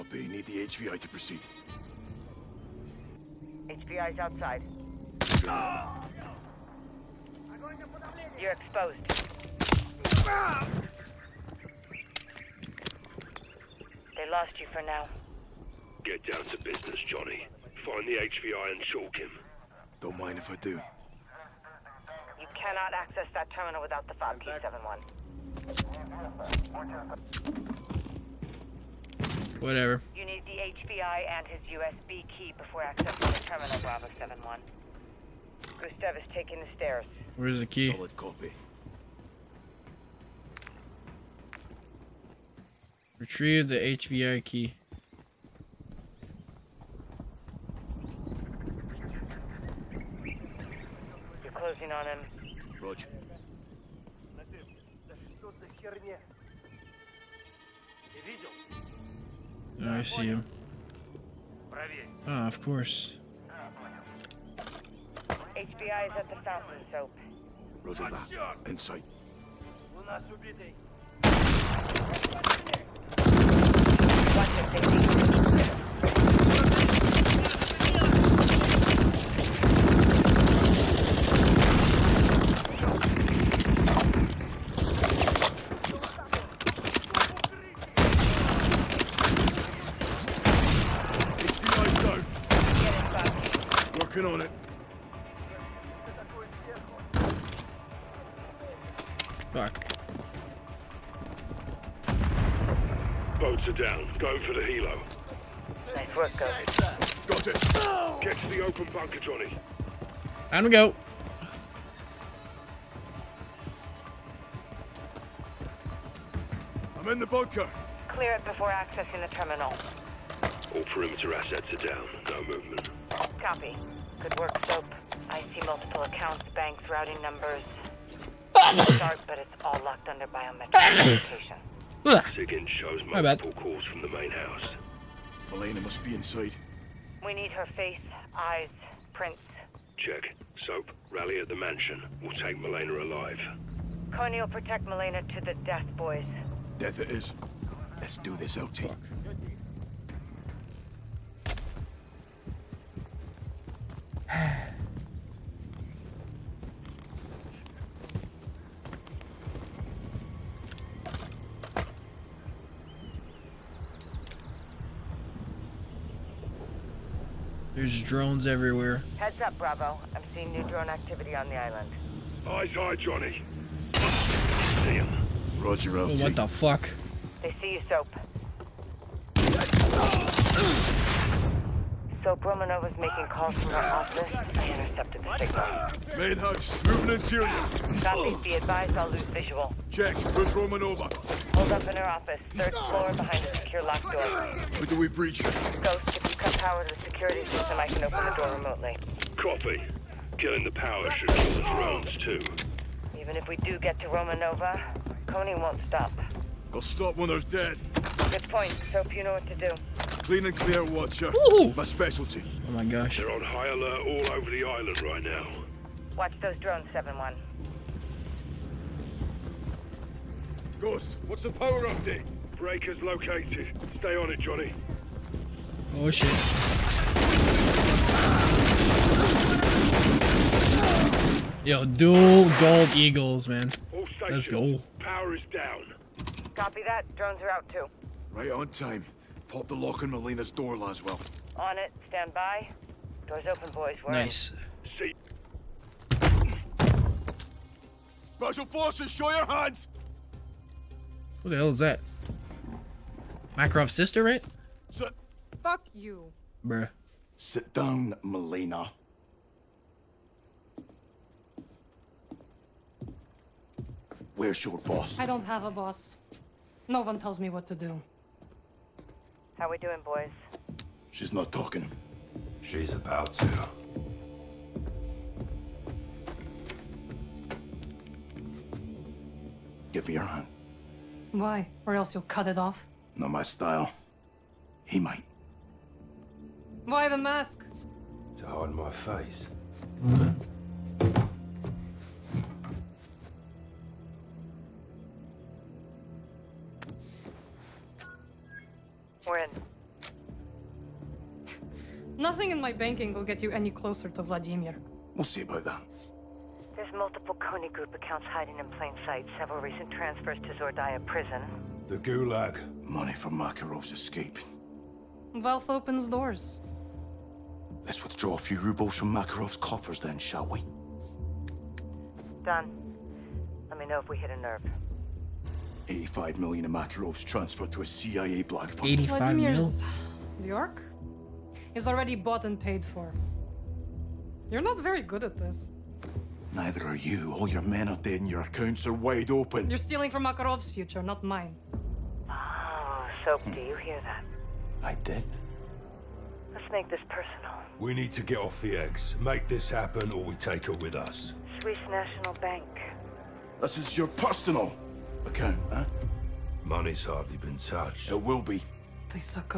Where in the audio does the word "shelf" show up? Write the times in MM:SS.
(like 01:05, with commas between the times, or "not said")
not said.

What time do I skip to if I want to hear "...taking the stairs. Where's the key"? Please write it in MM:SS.
00:36.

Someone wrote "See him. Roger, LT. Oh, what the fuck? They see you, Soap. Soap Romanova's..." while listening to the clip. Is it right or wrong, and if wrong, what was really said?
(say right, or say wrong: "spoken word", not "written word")
right.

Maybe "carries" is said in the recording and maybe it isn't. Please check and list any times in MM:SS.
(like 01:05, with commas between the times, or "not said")
not said.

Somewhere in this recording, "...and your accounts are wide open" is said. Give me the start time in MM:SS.
05:38.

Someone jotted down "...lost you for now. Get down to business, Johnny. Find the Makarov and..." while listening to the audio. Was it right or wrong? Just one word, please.
wrong.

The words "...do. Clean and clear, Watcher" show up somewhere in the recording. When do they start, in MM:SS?
03:29.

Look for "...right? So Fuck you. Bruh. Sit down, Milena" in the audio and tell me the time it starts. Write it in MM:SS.
04:14.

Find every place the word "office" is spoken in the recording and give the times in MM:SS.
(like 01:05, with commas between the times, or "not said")
03:03, 03:12.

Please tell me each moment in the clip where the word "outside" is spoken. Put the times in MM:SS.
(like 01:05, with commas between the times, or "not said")
00:04.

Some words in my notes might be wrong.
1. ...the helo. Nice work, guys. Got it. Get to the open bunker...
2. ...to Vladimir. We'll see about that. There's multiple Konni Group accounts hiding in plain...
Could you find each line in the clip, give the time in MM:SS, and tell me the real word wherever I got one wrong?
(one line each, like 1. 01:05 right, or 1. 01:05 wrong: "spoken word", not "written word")
1. 01:44 right
2. 05:04 right.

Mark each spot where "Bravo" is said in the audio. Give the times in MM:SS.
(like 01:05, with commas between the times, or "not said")
00:33, 02:49.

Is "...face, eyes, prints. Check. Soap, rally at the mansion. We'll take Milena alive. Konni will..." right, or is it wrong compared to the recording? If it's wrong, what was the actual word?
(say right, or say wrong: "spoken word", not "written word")
right.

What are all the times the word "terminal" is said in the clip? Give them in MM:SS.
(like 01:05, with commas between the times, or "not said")
00:23, 00:33, 01:59.